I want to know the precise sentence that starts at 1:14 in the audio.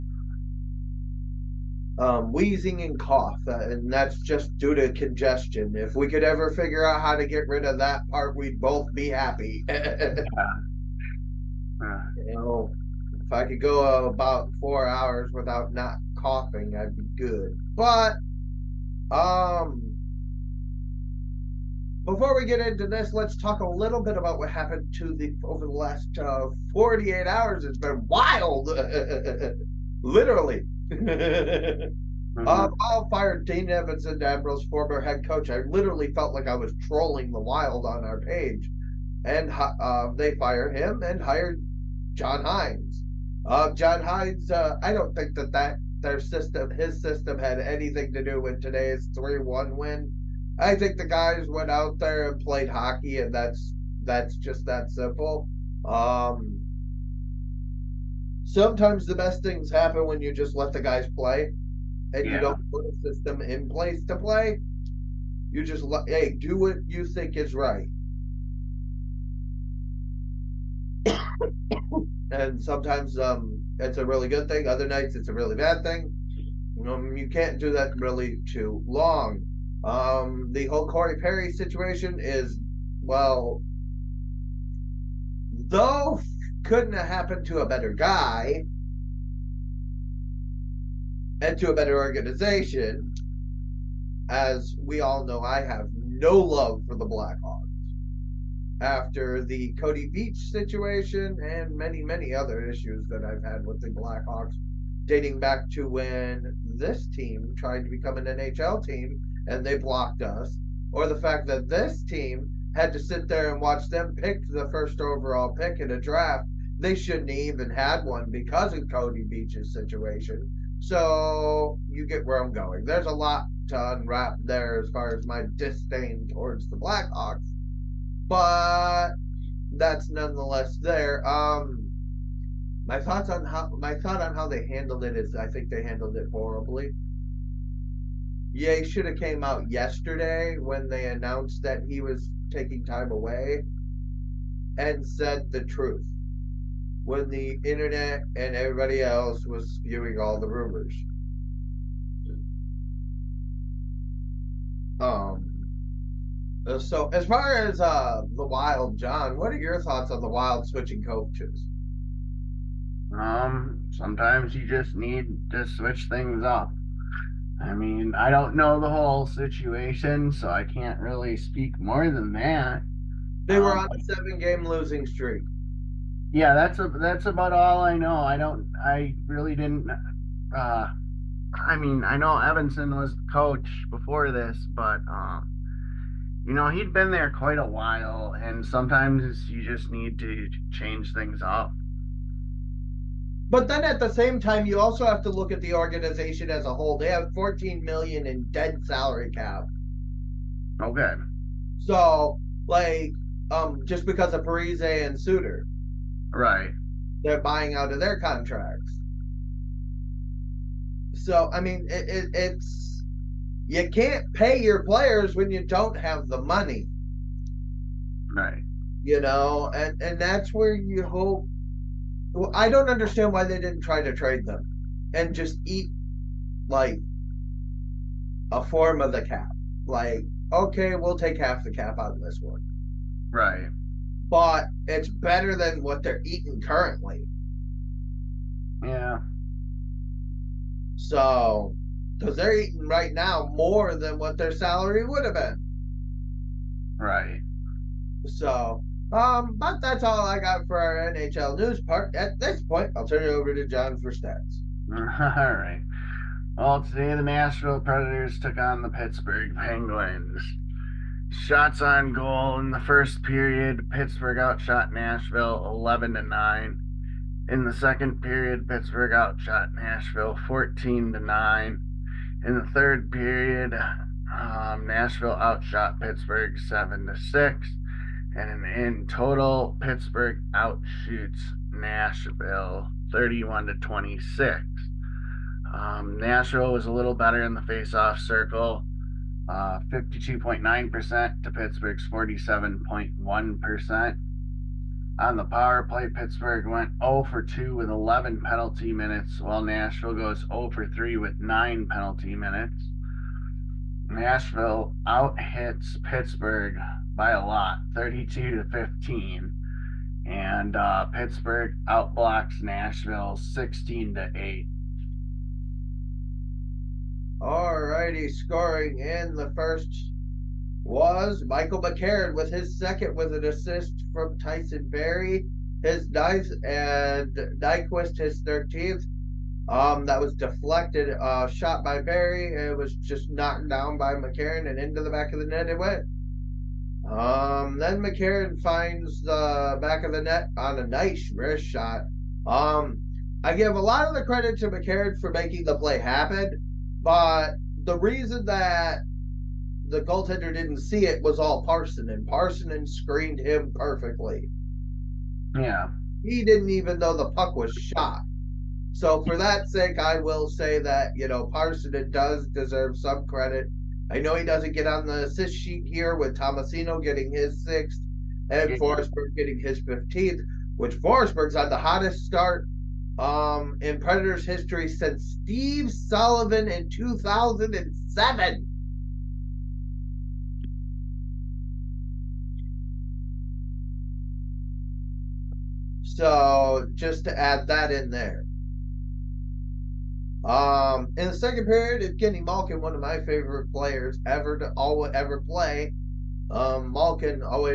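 Other nights, it's a really bad thing.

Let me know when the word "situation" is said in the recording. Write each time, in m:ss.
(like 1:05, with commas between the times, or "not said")
1:21, 1:40, 1:59, 2:49.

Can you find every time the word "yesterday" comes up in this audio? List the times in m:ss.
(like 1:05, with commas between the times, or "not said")
2:19.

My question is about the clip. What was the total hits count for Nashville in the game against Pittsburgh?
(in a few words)
32.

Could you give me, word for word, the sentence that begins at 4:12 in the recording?
At this point, I'll turn it over to John for stats.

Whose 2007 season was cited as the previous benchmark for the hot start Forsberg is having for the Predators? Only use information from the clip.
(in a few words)
Steve Sullivan.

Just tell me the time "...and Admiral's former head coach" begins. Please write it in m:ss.
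0:34.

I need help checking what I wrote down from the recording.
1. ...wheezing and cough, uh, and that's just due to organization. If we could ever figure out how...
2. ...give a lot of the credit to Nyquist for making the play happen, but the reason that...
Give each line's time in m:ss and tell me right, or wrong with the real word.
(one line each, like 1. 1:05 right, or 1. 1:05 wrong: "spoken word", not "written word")
1. 0:02 wrong: "congestion", not "organization"
2. 5:43 wrong: "McCarron", not "Nyquist".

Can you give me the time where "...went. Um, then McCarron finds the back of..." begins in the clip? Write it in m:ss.
5:35.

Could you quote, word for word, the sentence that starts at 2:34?
Um uh, so, as far as uh, the Wild, John, what are your thoughts on the Wild switching coaches?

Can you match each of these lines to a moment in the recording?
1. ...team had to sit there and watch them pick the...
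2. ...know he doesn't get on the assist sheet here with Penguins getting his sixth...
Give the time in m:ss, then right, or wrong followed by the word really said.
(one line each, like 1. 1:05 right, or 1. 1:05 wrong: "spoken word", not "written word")
1. 1:52 right
2. 6:04 wrong: "Tomasino", not "Penguins".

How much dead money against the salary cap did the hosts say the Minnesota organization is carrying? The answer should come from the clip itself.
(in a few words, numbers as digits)
14 million.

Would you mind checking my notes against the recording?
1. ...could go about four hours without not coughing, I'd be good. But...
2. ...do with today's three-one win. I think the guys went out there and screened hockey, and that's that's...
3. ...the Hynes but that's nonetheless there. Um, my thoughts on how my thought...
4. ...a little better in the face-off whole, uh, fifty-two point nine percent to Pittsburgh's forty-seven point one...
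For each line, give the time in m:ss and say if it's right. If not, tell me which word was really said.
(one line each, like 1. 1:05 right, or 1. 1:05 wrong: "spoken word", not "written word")
1. 0:13 right
2. 0:48 wrong: "played", not "screened"
3. 2:06 wrong: "Blackhawks", not "Hynes"
4. 4:46 wrong: "circle", not "whole".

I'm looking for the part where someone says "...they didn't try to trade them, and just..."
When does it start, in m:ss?
3:43.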